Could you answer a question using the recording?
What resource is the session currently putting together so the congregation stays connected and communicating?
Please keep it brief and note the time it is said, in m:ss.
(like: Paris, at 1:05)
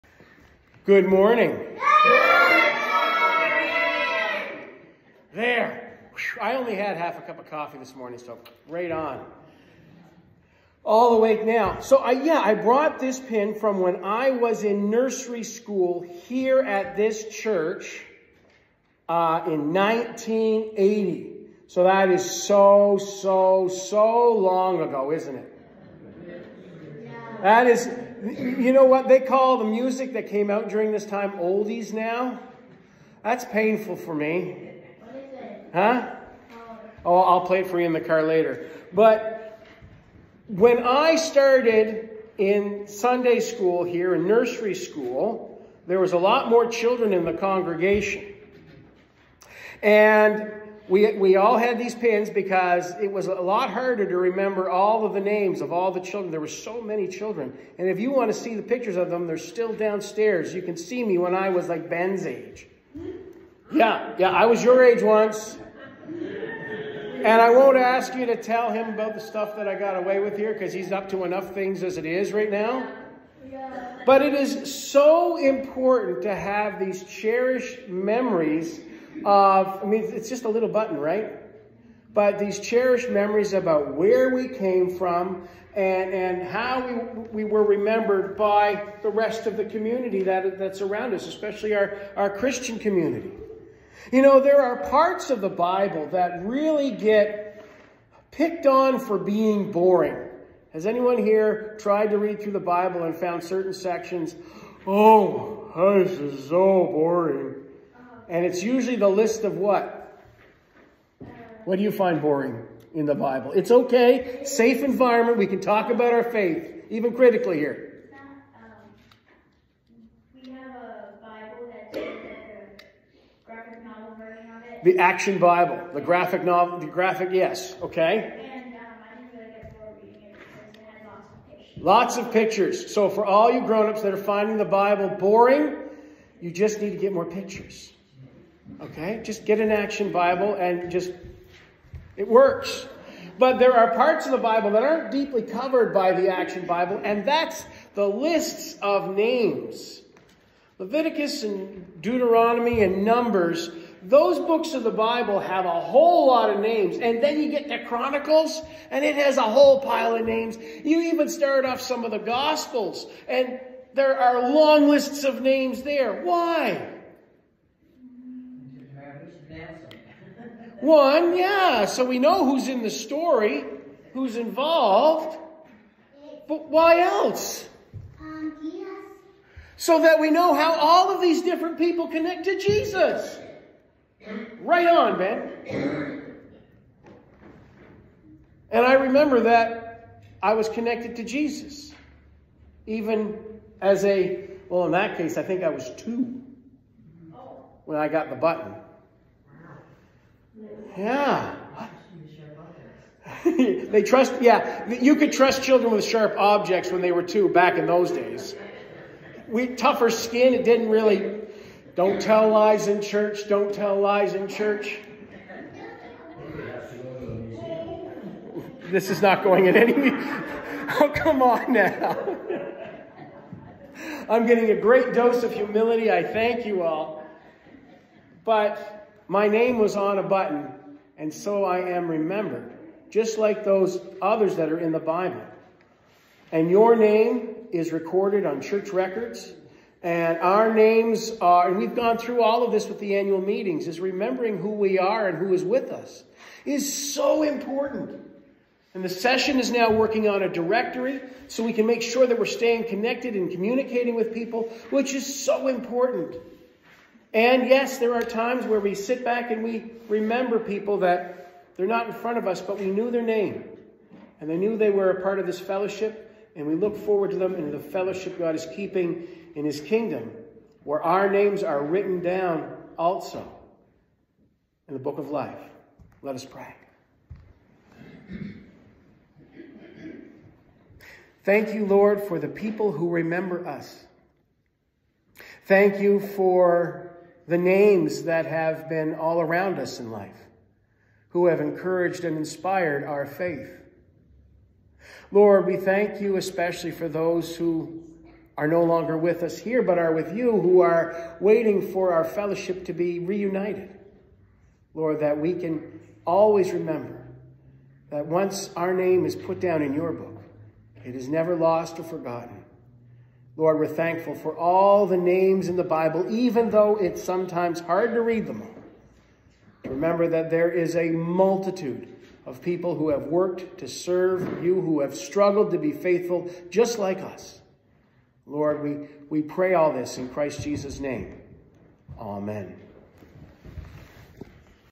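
A directory, at 4:10.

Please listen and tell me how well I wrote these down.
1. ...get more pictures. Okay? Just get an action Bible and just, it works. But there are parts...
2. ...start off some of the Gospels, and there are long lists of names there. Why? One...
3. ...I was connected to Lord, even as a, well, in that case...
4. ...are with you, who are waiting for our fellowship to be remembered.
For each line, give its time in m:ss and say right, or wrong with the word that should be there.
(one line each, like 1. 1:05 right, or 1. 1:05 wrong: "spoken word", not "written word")
1. 2:16 right
2. 2:41 right
3. 3:10 wrong: "Jesus", not "Lord"
4. 4:59 wrong: "reunited", not "remembered".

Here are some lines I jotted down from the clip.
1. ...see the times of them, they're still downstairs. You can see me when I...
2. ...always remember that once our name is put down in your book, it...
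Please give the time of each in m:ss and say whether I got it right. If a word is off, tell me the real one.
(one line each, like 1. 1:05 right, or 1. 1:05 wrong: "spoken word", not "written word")
1. 0:58 wrong: "pictures", not "times"
2. 5:06 right.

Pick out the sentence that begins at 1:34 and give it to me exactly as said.
You know, there are parts of the Bible that really get picked on for being boring.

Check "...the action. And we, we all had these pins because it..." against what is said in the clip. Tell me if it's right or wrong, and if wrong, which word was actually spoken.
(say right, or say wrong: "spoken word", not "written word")
wrong: "congregation", not "action".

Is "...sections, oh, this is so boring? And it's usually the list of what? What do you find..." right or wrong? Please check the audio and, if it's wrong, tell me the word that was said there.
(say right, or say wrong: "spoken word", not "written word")
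right.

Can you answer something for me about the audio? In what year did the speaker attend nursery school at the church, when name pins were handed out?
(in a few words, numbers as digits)
1980.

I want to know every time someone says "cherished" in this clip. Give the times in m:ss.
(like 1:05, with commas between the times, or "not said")
1:17, 1:22.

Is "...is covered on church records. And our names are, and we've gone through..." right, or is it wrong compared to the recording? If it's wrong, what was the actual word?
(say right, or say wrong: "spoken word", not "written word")
wrong: "recorded", not "covered".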